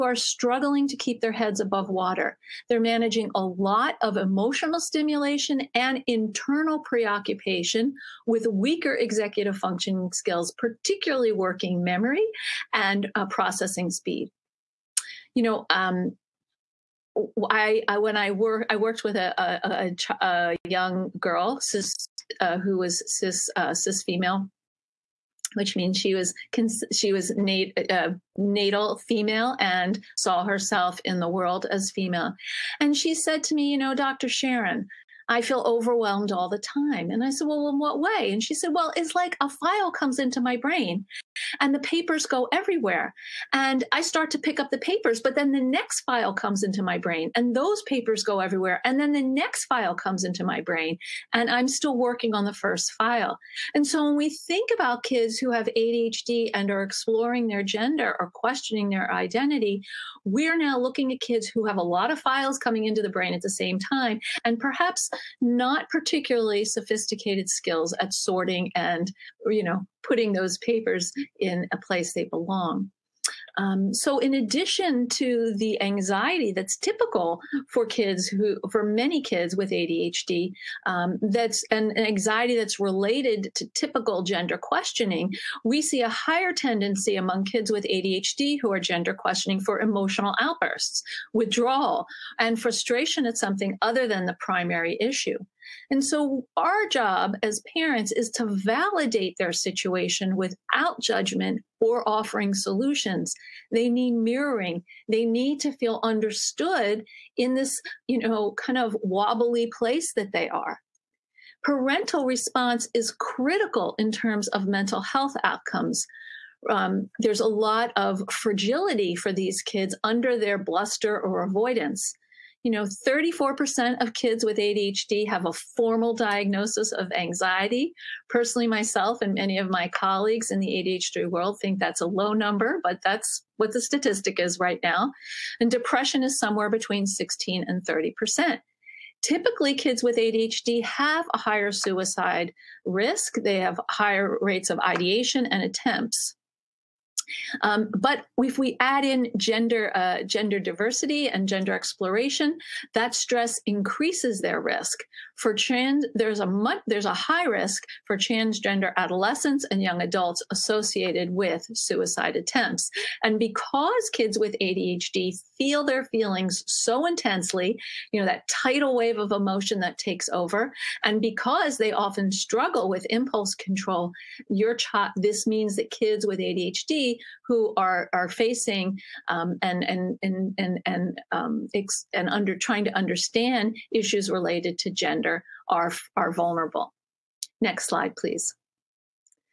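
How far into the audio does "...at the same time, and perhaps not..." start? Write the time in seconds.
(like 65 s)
63 s.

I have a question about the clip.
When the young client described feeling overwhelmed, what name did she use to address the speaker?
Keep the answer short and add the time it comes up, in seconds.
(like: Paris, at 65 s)
Dr. Sharon, at 33 s.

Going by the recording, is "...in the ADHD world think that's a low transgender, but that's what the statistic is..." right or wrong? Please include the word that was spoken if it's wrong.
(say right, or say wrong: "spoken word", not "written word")
wrong: "number", not "transgender".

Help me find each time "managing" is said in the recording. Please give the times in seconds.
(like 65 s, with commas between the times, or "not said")
2 s.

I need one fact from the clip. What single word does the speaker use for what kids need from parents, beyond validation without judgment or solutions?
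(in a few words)
mirroring.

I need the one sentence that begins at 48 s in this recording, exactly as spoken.
And then the next file comes into my brain, and I'm still working on the first file.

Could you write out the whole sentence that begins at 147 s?
Um, but if we add in gender, uh, gender diversity and gender exploration, that stress increases their risk.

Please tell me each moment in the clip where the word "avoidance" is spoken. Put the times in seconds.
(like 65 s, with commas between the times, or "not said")
121 s.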